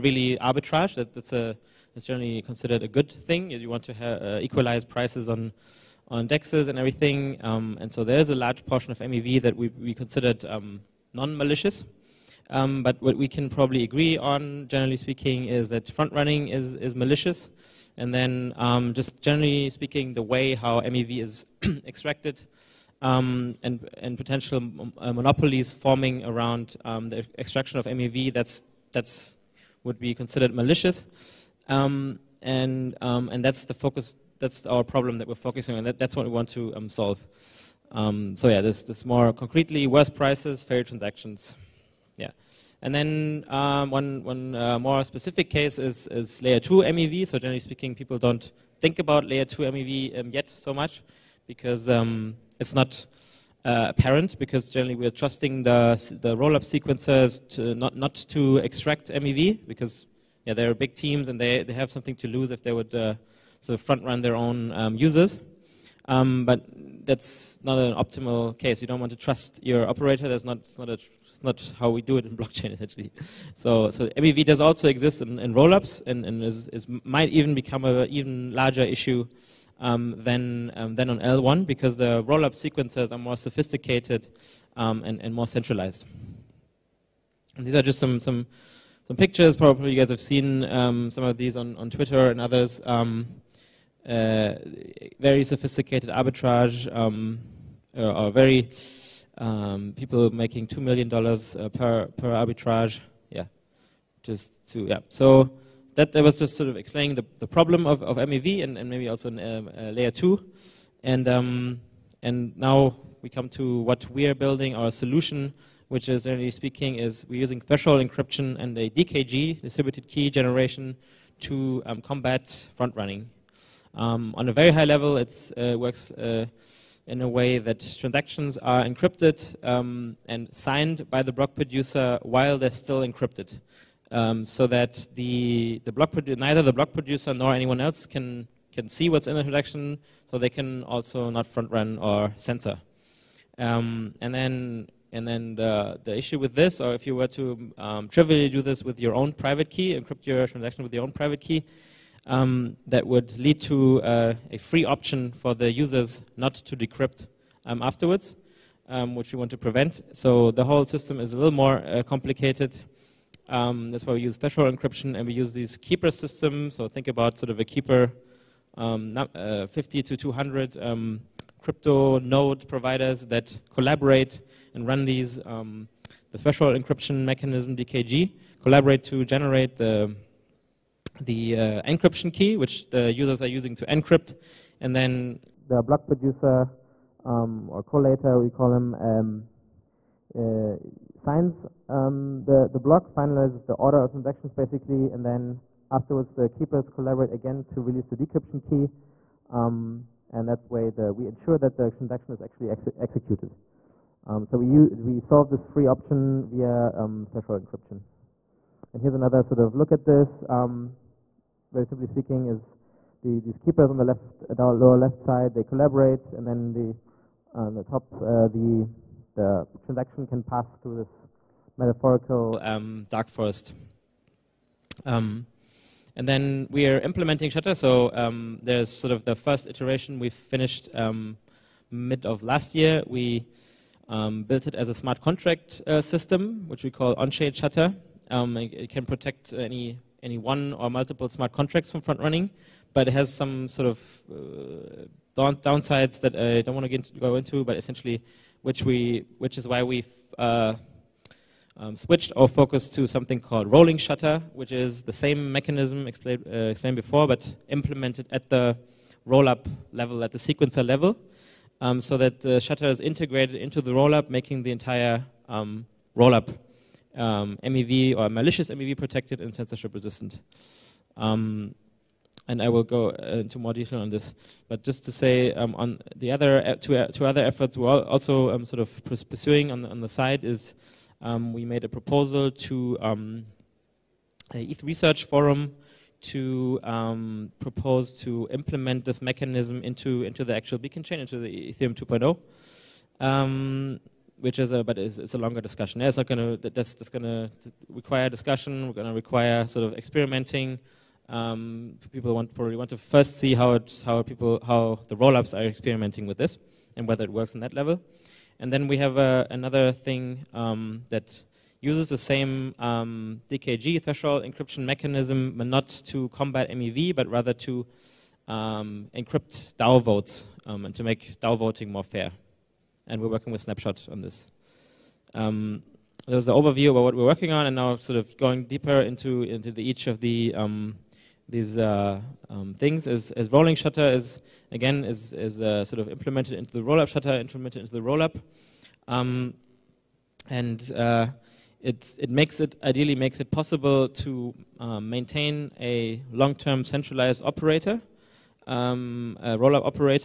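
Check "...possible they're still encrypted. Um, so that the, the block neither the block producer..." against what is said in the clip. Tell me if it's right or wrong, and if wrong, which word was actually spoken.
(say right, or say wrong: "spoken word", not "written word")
wrong: "while", not "possible".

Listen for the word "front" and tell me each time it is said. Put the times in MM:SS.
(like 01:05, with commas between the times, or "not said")
00:15, 01:03, 02:02, 02:21, 04:02.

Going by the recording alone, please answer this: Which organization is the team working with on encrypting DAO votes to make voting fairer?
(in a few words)
Snapshot.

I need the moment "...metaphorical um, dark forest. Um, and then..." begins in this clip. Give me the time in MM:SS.
03:41.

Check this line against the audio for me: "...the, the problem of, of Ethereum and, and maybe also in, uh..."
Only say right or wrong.
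wrong.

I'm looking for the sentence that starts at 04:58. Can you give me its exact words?
We're going to require sort of experimenting.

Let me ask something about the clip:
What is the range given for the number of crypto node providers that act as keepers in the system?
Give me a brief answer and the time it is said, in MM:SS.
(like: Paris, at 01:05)
50 to 200, at 02:49.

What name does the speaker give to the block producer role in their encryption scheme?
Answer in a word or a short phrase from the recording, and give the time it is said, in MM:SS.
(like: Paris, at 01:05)
collator, at 03:07.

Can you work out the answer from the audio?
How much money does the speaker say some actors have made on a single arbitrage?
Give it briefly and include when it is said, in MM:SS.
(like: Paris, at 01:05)
2 million dollars, at 01:40.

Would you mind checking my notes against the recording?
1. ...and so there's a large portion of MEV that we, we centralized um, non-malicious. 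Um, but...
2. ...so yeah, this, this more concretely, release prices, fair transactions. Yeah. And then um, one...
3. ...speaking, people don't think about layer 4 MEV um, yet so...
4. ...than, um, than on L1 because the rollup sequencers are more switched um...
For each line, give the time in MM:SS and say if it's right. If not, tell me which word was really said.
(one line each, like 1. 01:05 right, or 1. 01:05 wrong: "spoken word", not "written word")
1. 00:07 wrong: "considered", not "centralized"
2. 00:38 wrong: "worse", not "release"
3. 00:47 wrong: "2", not "4"
4. 01:20 wrong: "sophisticated", not "switched".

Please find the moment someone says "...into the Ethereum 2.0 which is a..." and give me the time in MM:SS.
04:51.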